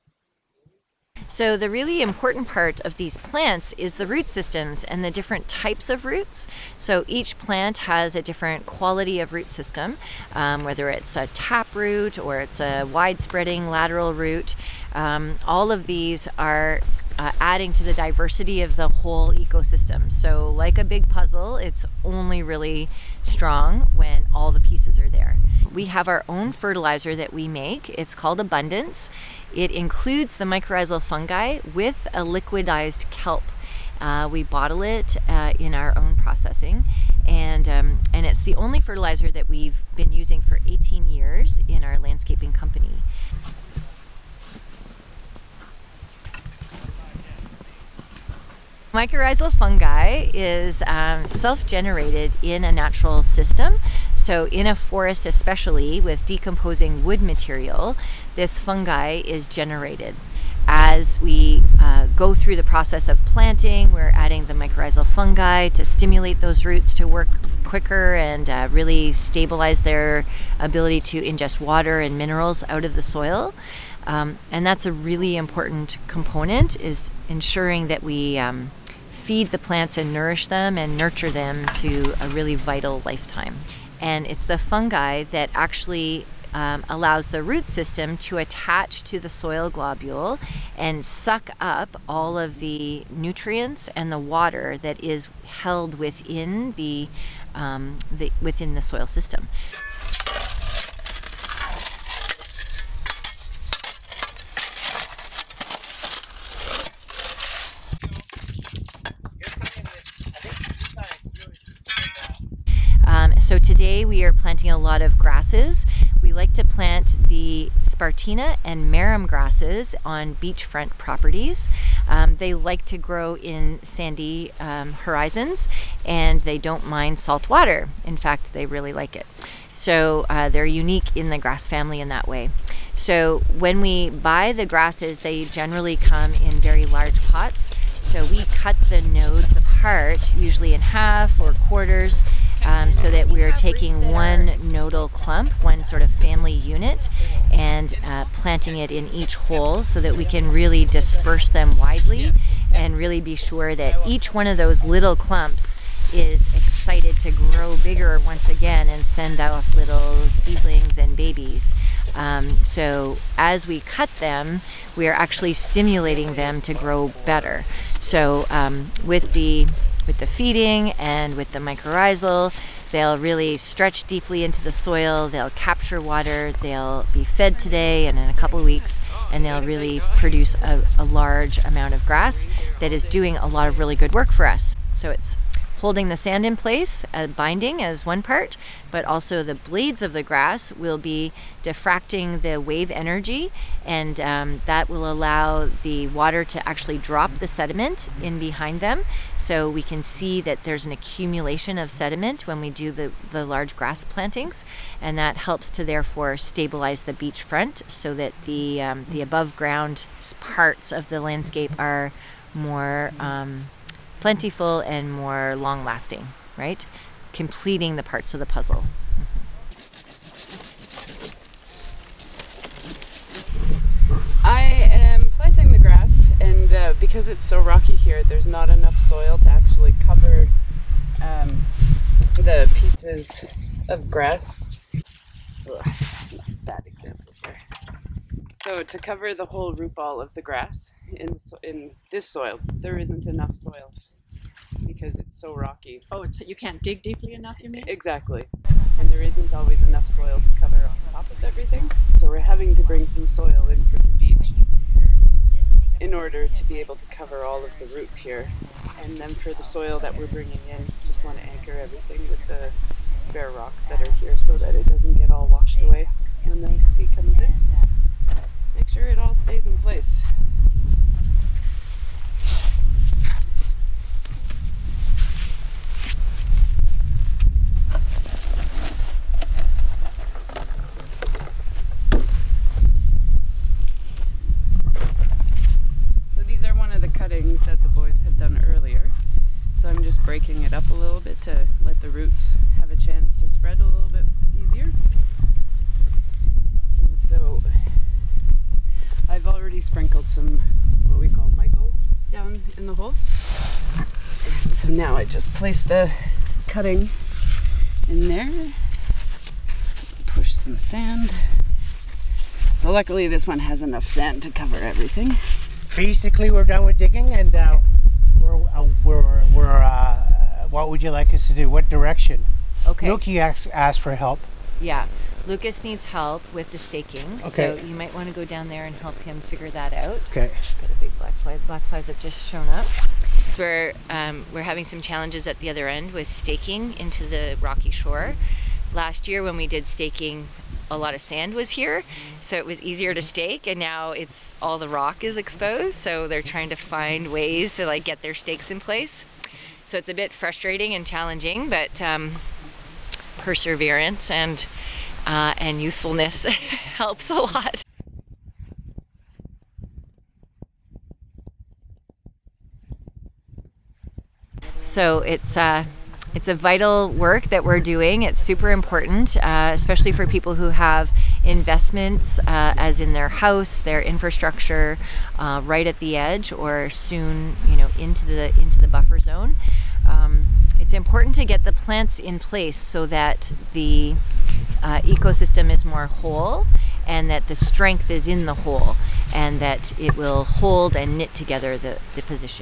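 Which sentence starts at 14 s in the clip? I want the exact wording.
Um, all of these are adding to the diversity of the whole ecosystem.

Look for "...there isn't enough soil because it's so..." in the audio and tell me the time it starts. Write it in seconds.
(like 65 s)
242 s.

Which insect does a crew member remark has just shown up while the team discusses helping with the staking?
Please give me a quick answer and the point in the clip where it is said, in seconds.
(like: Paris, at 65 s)
black fly, at 331 s.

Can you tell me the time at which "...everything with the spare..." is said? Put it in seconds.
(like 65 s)
261 s.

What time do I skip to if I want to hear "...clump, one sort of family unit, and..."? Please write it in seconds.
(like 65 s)
145 s.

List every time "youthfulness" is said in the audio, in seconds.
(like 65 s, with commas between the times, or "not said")
355 s.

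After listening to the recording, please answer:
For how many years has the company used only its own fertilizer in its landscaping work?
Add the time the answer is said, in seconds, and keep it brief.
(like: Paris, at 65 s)
18, at 40 s.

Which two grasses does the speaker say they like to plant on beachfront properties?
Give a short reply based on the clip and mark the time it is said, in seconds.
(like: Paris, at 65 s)
spartina and marram, at 117 s.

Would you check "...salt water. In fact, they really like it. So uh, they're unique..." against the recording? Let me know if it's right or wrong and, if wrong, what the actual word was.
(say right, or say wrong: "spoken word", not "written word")
right.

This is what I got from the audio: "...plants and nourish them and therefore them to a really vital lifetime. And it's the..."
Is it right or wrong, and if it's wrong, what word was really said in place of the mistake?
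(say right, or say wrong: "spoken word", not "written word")
wrong: "nurture", not "therefore".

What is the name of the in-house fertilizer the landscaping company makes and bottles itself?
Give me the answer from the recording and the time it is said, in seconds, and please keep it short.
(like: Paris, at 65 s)
Abundance, at 28 s.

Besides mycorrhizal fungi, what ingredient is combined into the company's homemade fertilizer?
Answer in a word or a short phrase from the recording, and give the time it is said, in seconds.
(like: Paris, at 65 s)
liquidized kelp, at 32 s.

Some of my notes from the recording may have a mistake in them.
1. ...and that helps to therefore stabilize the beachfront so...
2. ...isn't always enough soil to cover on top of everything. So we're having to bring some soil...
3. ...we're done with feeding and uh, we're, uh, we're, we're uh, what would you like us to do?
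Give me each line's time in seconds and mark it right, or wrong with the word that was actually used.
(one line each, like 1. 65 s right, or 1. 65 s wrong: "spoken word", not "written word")
1. 205 s right
2. 249 s right
3. 316 s wrong: "digging", not "feeding".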